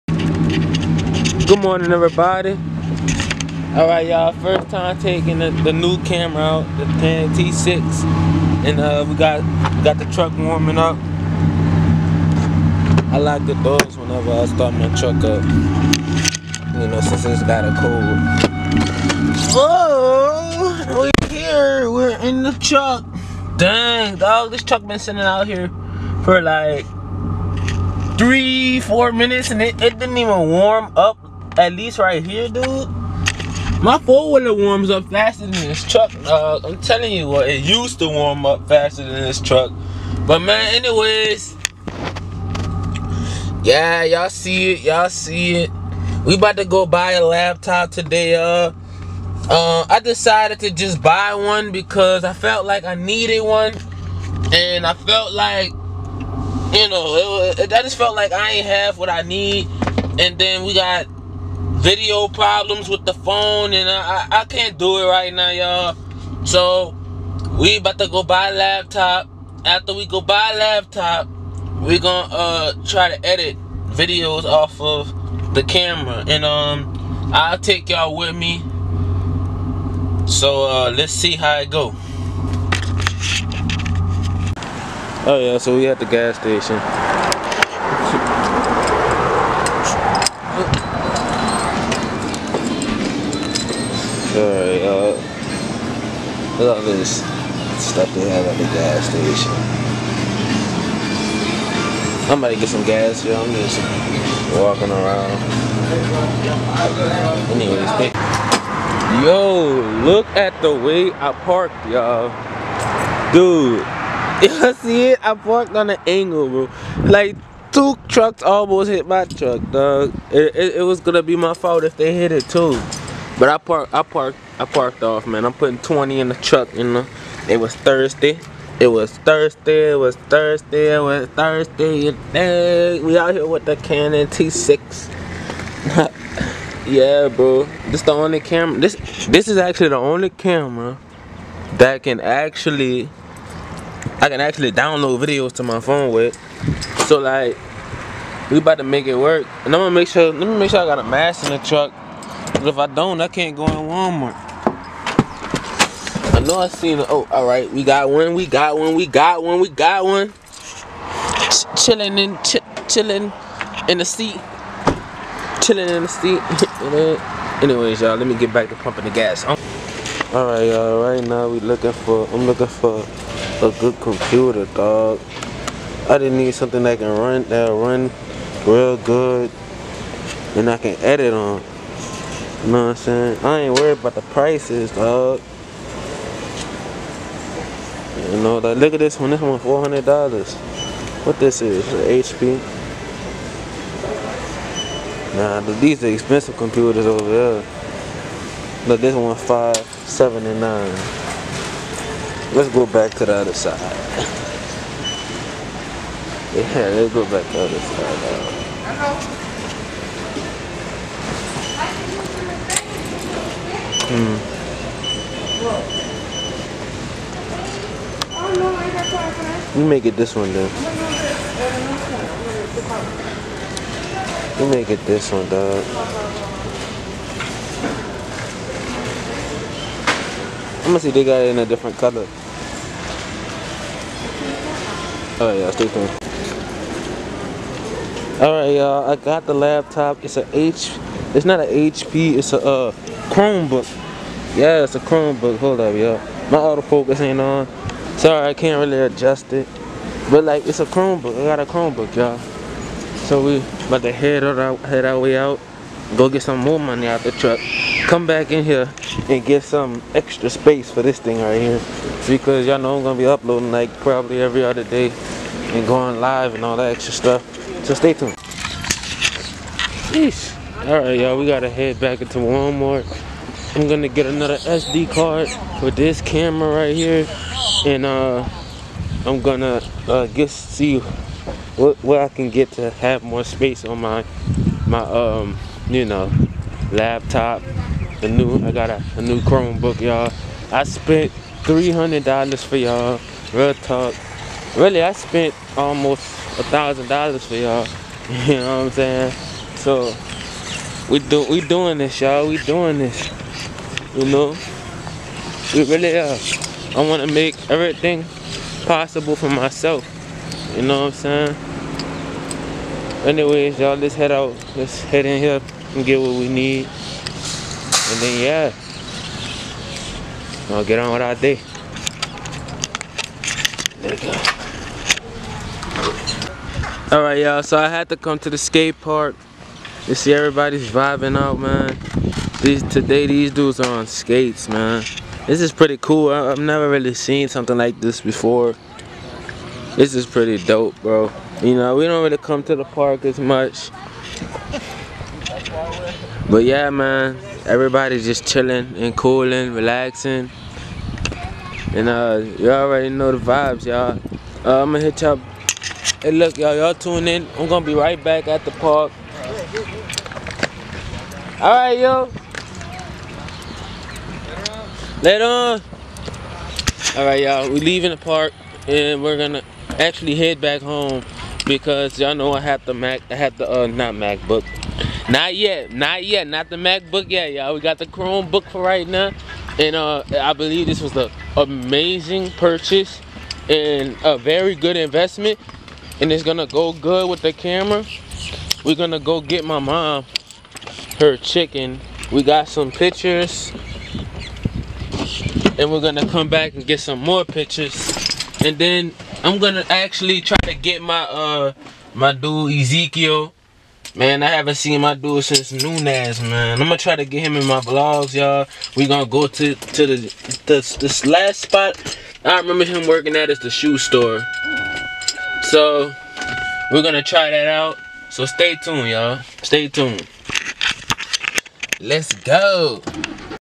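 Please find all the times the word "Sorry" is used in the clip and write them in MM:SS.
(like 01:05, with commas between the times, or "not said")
04:08.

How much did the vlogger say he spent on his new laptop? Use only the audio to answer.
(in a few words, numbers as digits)
$300.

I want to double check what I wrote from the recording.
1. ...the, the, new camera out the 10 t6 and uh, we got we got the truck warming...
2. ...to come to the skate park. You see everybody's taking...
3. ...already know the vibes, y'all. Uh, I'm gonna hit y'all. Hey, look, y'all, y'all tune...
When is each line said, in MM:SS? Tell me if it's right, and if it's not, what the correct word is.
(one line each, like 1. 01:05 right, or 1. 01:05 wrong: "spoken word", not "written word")
1. 00:05 right
2. 05:28 wrong: "vibing", not "taking"
3. 05:52 right.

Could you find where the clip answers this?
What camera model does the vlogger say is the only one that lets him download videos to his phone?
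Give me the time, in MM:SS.
02:13.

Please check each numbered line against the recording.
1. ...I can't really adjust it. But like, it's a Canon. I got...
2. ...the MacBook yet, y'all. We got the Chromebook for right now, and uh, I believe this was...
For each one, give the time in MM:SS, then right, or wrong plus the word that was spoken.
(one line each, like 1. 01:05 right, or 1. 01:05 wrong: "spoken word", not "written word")
1. 04:08 wrong: "Chromebook", not "Canon"
2. 06:16 right.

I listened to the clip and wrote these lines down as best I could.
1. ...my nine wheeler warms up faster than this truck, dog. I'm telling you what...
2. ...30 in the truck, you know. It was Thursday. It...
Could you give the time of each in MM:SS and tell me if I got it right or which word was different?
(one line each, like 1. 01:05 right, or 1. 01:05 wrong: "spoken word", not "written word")
1. 00:33 wrong: "four", not "nine"
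2. 02:05 wrong: "20", not "30".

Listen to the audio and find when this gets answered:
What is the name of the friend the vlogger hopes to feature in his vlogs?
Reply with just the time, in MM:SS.
06:42.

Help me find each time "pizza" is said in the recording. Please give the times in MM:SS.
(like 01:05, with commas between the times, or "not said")
not said.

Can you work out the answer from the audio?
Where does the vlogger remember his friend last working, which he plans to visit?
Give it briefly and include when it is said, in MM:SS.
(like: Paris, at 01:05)
the shoe store, at 06:53.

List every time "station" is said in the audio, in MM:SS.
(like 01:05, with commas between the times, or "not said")
01:26, 01:39.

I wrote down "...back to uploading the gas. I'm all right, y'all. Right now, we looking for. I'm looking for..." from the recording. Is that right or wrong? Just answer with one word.
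wrong.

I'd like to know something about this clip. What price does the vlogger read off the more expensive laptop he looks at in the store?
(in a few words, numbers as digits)
579.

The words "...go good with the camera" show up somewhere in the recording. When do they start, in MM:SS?
06:26.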